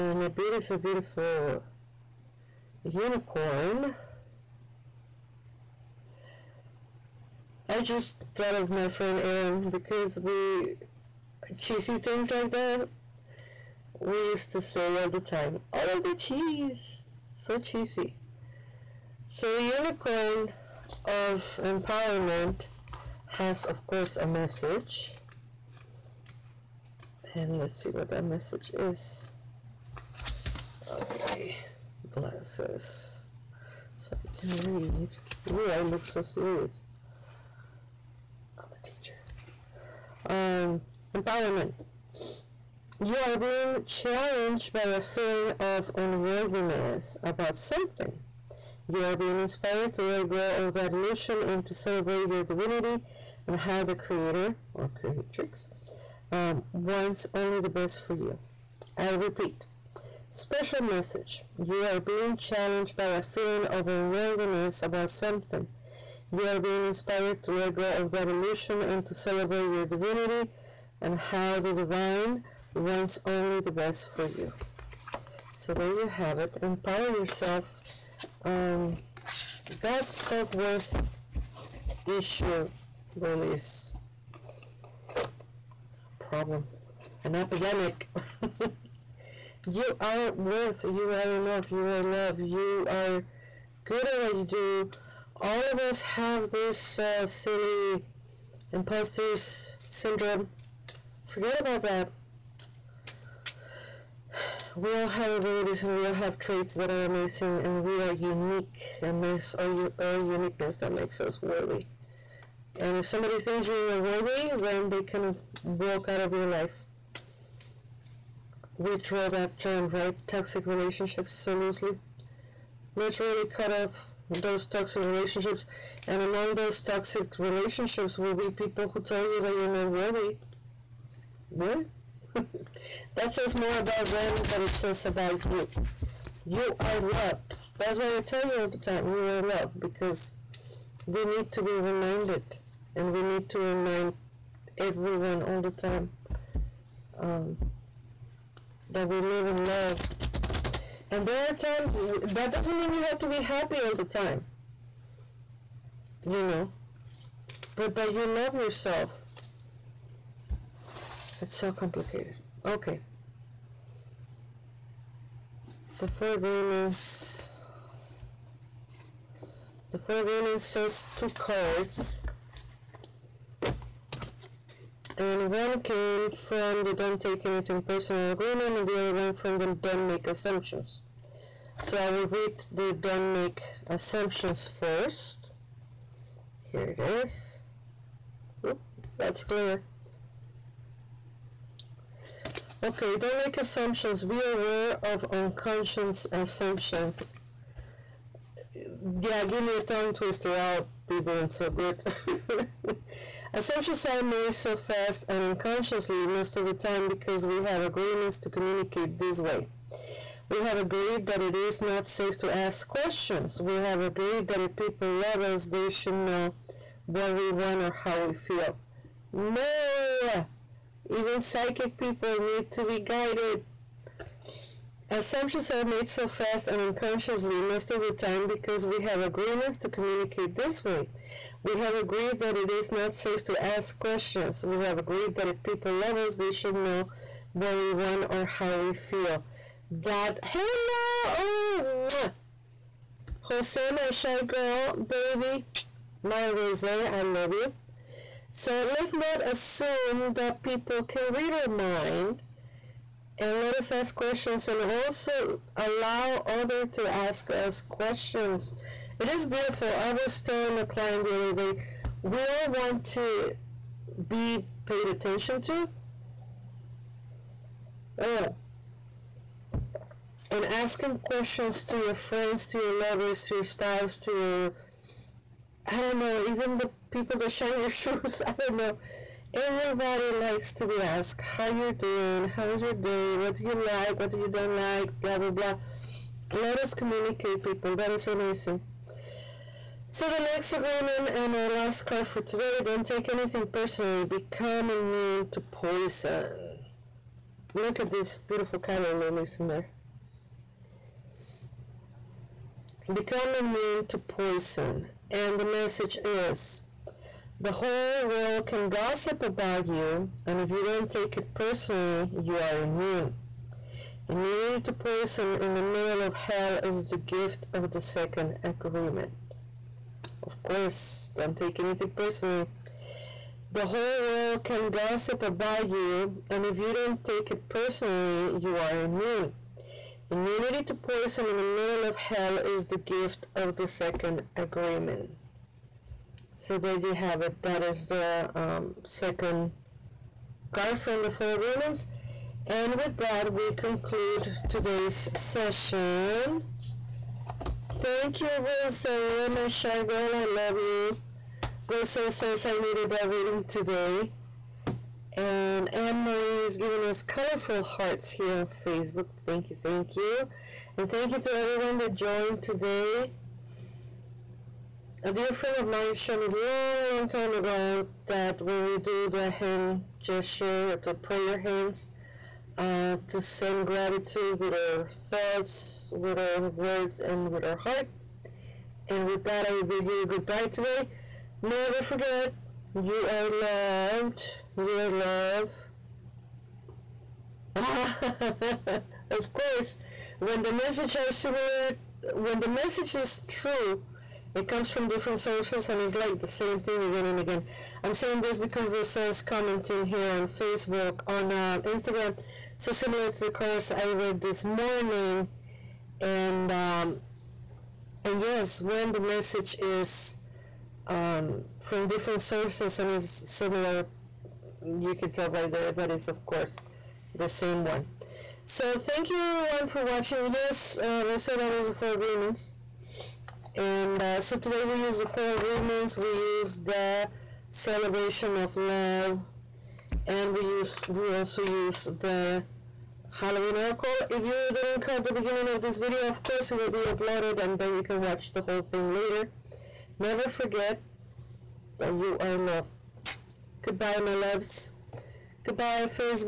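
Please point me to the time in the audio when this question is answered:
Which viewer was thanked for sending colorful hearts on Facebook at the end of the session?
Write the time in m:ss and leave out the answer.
5:55.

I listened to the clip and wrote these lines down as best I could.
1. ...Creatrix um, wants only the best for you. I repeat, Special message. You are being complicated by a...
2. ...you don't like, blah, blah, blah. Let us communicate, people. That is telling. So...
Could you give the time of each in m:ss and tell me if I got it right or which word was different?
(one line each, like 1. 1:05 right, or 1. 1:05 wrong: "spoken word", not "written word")
1. 0:54 wrong: "challenged", not "complicated"
2. 4:44 wrong: "amazing", not "telling".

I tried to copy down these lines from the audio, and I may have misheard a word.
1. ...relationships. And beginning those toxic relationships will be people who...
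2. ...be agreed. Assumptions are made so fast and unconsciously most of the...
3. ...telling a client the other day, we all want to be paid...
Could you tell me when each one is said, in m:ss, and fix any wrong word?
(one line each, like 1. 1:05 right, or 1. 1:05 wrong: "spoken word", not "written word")
1. 2:05 wrong: "among", not "beginning"
2. 3:42 wrong: "guided", not "agreed"
3. 4:20 right.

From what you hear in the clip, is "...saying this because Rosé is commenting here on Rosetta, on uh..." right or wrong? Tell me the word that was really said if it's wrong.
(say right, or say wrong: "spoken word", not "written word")
wrong: "Facebook", not "Rosetta".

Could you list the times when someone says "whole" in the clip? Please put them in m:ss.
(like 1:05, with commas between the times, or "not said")
5:07, 5:23, 7:18.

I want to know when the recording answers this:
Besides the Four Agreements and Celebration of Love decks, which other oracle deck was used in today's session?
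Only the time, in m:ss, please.
7:13.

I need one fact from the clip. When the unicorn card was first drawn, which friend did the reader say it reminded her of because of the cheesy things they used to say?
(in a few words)
Aaron.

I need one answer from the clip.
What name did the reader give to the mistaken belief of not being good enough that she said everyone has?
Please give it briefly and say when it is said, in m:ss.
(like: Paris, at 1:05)
imposters syndrome, at 1:38.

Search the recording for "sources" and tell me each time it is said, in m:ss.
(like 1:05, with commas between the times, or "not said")
6:35, 6:52.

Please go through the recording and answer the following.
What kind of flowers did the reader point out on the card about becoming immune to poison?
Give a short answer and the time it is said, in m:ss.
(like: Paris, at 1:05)
calla lilies, at 4:58.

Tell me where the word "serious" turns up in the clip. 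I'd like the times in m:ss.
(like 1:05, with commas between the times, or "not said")
0:36.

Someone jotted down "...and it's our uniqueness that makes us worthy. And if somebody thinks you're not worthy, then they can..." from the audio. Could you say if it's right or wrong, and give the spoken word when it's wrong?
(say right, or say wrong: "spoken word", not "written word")
right.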